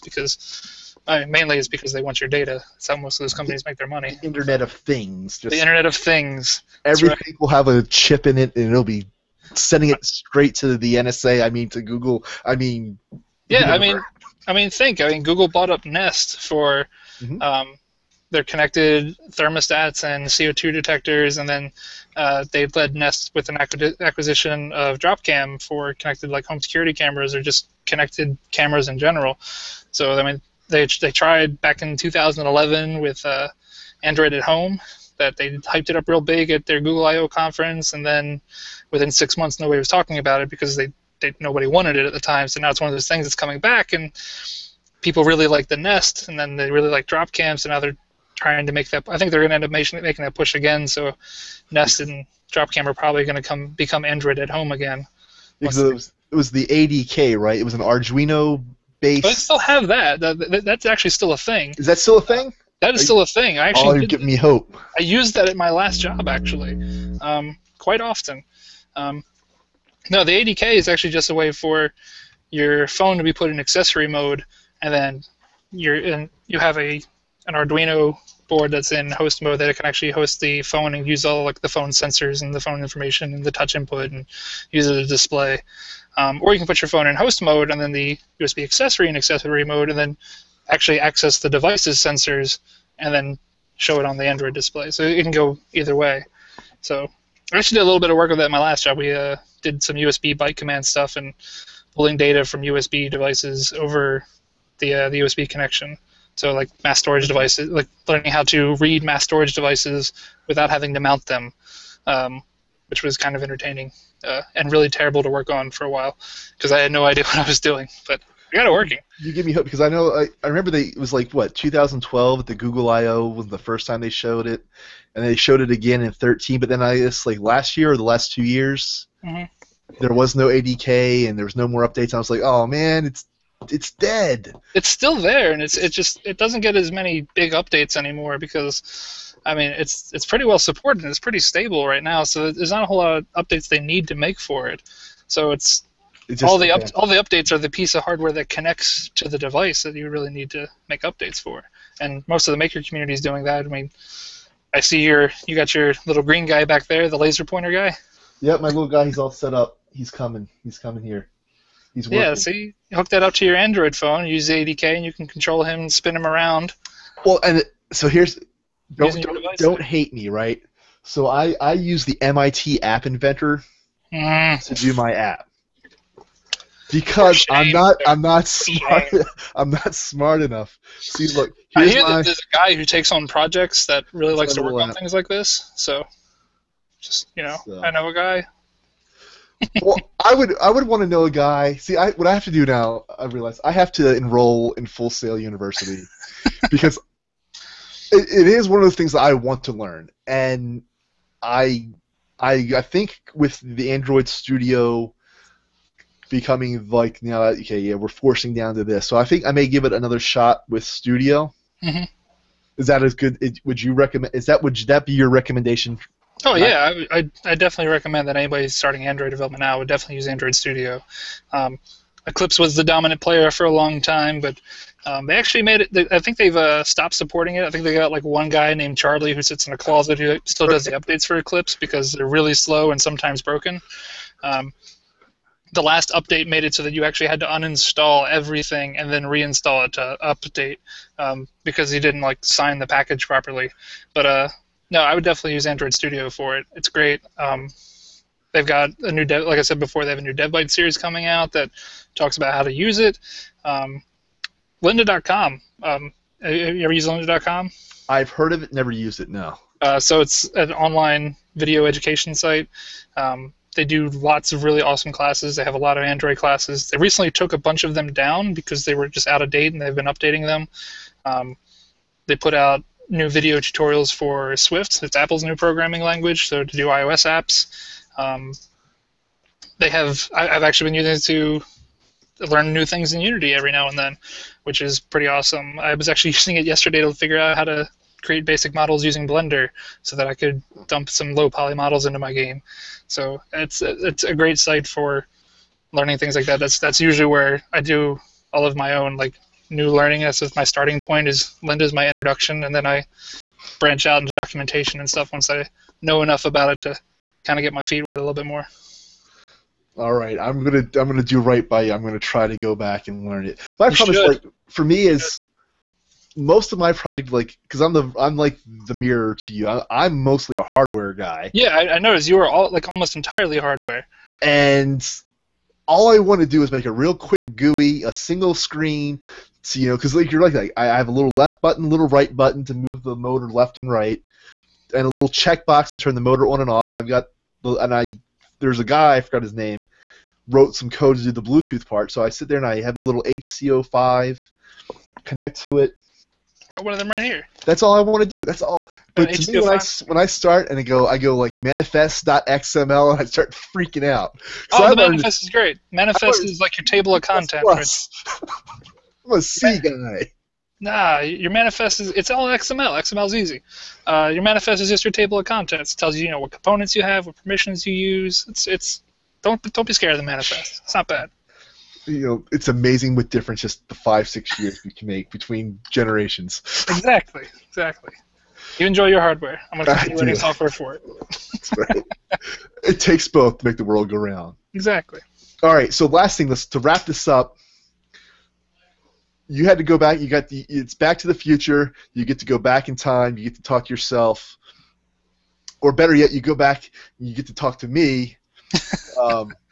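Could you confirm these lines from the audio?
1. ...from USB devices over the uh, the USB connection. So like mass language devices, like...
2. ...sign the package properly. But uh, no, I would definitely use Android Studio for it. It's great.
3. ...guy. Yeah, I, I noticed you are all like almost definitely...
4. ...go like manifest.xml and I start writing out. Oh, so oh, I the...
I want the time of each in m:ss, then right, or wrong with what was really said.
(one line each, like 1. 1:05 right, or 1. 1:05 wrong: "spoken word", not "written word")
1. 1:42 wrong: "storage", not "language"
2. 4:02 right
3. 5:21 wrong: "entirely", not "definitely"
4. 5:51 wrong: "freaking", not "writing".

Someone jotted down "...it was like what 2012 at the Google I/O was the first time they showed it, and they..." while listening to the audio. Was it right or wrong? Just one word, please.
right.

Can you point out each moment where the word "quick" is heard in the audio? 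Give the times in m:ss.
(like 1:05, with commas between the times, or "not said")
5:27.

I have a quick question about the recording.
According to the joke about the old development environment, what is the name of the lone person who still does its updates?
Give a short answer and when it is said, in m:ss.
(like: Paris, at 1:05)
Charlie, at 3:48.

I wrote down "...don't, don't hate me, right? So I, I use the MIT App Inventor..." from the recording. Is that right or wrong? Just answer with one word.
right.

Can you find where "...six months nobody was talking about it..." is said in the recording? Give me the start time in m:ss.
0:39.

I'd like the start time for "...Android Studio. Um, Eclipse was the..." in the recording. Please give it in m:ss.
3:40.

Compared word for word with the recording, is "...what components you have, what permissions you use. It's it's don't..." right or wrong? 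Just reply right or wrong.
right.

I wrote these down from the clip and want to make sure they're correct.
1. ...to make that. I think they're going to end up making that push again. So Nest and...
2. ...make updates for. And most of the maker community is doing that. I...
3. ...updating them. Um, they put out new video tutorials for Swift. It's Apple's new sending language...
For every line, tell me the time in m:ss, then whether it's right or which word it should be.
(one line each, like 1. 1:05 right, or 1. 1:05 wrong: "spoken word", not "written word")
1. 0:48 right
2. 2:30 right
3. 4:30 wrong: "programming", not "sending".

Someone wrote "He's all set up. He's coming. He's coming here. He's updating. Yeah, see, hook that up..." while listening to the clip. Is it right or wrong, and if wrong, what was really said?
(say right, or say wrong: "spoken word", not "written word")
wrong: "working", not "updating".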